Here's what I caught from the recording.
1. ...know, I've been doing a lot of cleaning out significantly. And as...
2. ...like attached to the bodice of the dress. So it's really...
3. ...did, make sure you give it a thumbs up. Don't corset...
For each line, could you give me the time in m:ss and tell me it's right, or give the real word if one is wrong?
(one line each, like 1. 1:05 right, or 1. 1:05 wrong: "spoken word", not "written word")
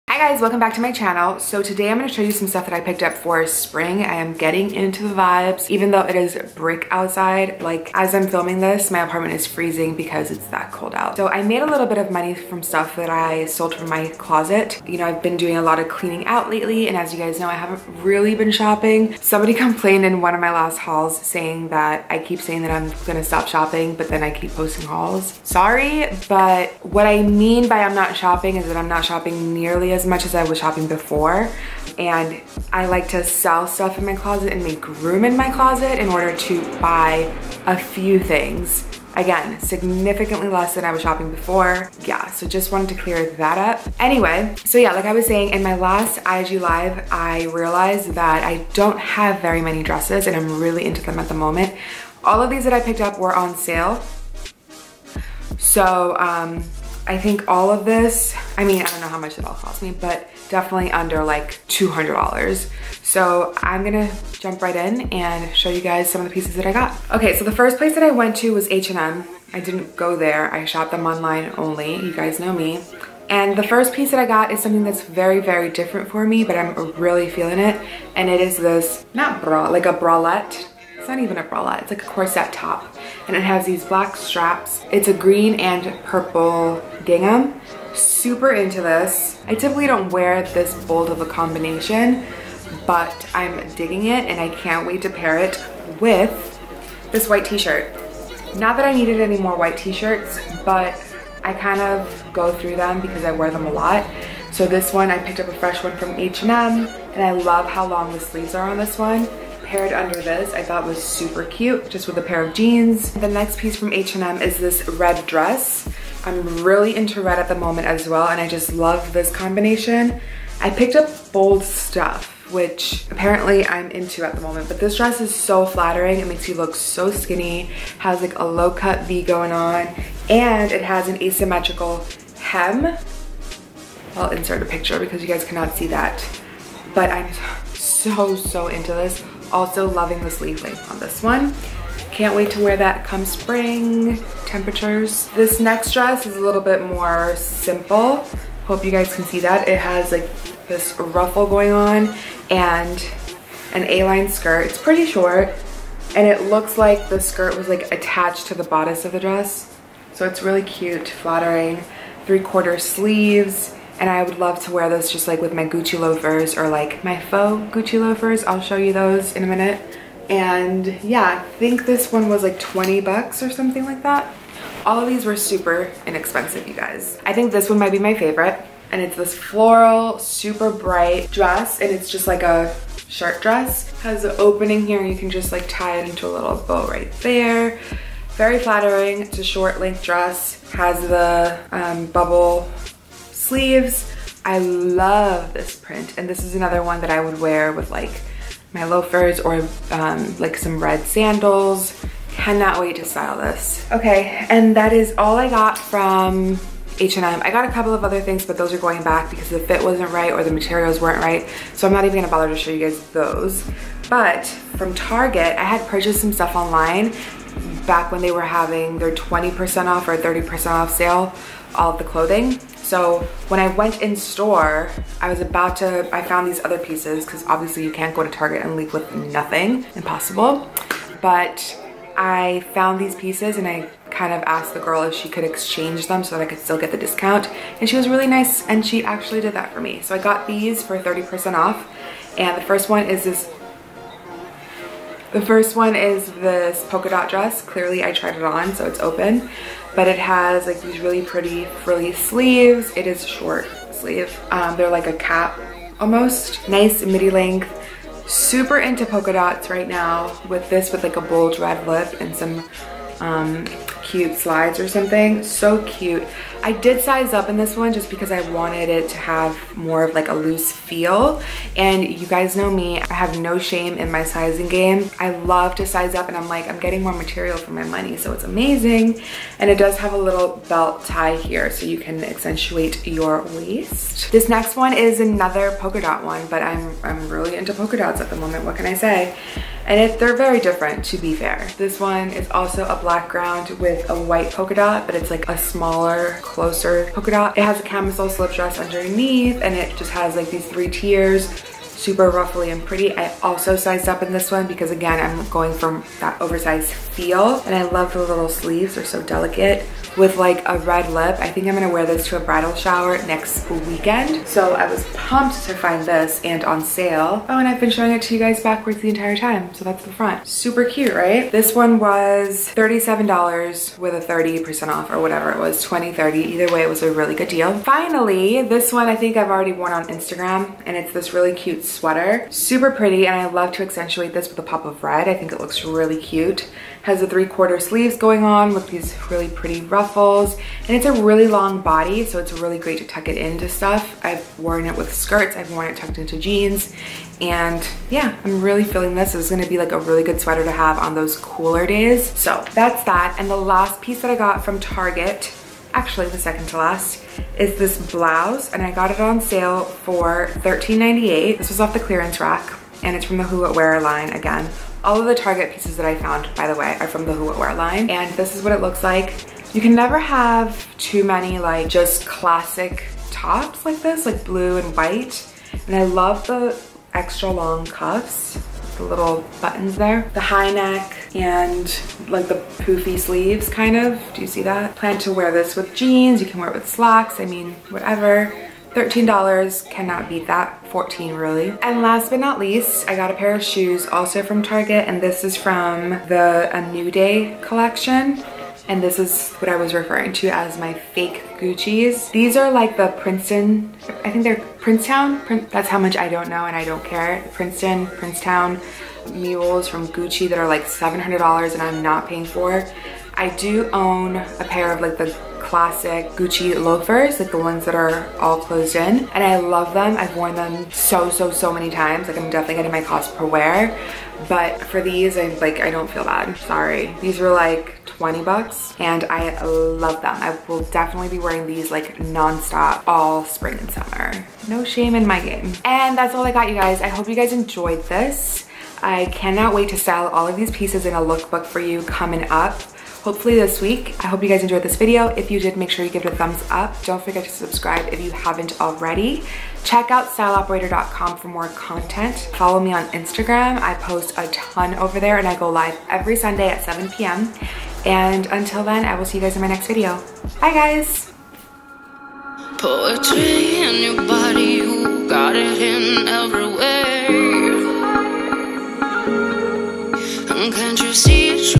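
1. 0:14 wrong: "lately", not "significantly"
2. 2:37 right
3. 7:25 wrong: "forget", not "corset".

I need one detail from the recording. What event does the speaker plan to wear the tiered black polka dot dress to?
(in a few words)
A bridal shower.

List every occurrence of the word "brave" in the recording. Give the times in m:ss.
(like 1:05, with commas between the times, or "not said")
not said.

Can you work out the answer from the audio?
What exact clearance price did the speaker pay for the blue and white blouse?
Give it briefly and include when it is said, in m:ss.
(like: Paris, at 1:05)
$13.98, at 6:00.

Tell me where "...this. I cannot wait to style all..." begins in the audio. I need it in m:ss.
7:18.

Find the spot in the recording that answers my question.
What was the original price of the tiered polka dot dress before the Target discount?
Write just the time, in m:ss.
5:22.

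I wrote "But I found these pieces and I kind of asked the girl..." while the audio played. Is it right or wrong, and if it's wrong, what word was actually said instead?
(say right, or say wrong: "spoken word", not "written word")
right.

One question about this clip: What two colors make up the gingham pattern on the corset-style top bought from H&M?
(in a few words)
Green and purple.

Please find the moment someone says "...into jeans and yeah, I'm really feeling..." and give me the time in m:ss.
5:46.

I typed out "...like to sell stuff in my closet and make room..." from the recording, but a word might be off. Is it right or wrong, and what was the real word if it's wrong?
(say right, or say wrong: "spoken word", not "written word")
right.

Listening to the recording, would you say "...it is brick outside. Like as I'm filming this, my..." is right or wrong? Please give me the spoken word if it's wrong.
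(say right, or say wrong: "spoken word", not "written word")
right.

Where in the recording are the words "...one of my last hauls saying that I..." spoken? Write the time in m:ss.
0:20.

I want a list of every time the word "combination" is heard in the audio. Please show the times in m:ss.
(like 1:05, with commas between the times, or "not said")
1:31, 1:59.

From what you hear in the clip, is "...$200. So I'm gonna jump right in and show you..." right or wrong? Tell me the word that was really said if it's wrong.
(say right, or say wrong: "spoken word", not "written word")
right.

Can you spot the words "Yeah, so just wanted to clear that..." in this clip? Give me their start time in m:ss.
0:42.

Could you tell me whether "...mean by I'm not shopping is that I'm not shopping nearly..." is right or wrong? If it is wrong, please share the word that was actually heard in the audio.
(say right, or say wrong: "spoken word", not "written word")
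right.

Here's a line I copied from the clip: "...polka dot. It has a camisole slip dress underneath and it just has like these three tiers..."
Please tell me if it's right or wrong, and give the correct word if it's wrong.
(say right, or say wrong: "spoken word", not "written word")
right.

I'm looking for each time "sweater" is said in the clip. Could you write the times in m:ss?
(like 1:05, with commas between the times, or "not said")
5:31, 5:50.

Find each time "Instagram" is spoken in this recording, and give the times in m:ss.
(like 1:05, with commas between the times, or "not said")
5:30, 7:33.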